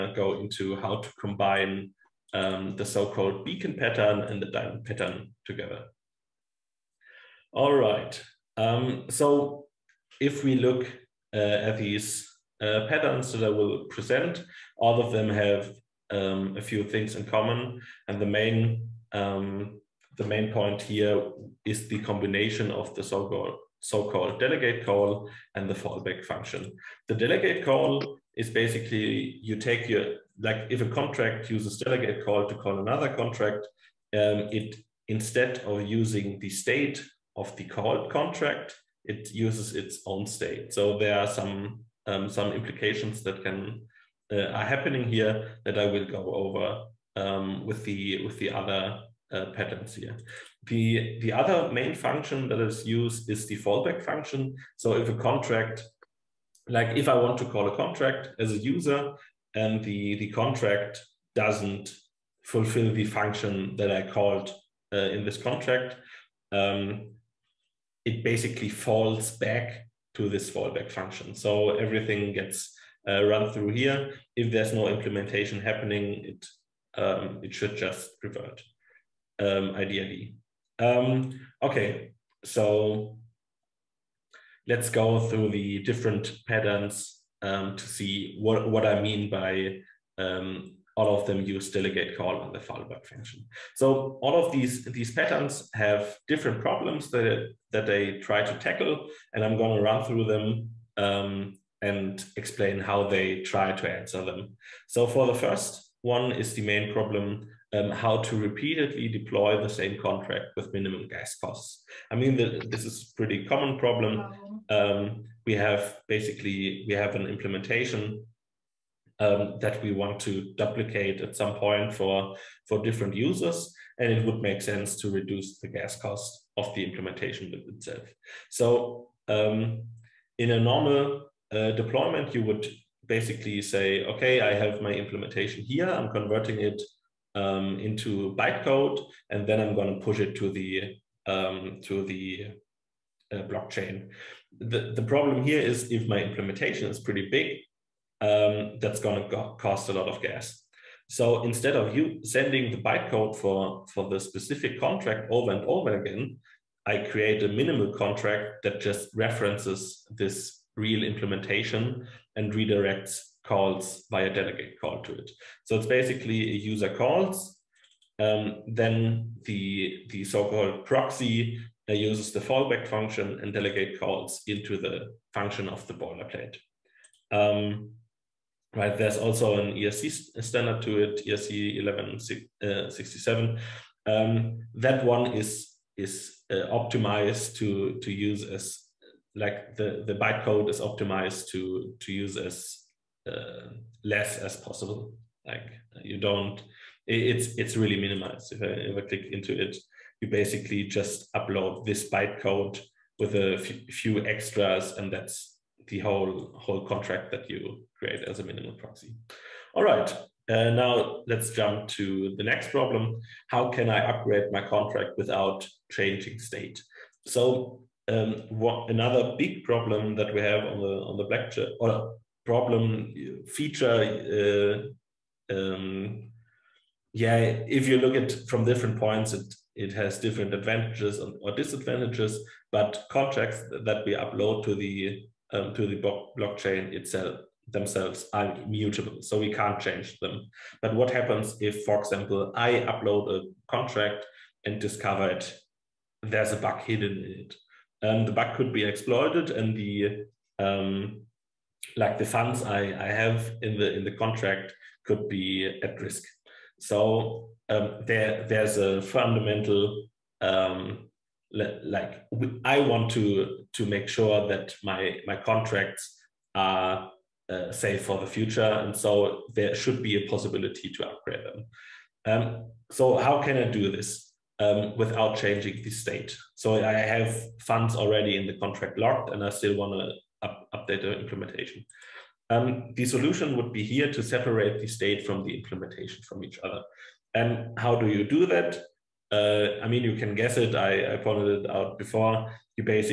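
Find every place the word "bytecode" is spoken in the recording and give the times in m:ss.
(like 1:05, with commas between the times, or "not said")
2:18, 2:32, 3:10, 3:22.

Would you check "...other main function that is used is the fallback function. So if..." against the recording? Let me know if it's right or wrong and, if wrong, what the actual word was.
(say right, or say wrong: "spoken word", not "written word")
right.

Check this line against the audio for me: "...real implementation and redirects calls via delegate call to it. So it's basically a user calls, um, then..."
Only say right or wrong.
right.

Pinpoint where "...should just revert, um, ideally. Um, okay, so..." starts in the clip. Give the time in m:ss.
1:17.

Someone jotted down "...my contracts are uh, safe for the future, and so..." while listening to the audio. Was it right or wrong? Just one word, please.
right.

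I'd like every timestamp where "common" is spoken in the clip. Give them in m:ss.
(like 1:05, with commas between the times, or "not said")
0:17, 1:53.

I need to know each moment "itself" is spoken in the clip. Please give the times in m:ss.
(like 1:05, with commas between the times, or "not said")
2:07, 3:56.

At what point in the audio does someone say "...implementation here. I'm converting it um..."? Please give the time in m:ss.
2:14.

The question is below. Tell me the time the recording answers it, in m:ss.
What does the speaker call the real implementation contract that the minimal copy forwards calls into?
2:55.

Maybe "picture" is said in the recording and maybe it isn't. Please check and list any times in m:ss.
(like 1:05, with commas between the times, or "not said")
not said.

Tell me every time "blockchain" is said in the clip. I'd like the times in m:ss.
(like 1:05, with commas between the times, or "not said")
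2:23, 3:56.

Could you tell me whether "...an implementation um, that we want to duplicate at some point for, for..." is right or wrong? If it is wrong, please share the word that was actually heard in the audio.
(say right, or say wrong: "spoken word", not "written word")
right.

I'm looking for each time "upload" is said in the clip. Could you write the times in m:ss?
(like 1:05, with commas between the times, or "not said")
3:21, 3:54, 4:02.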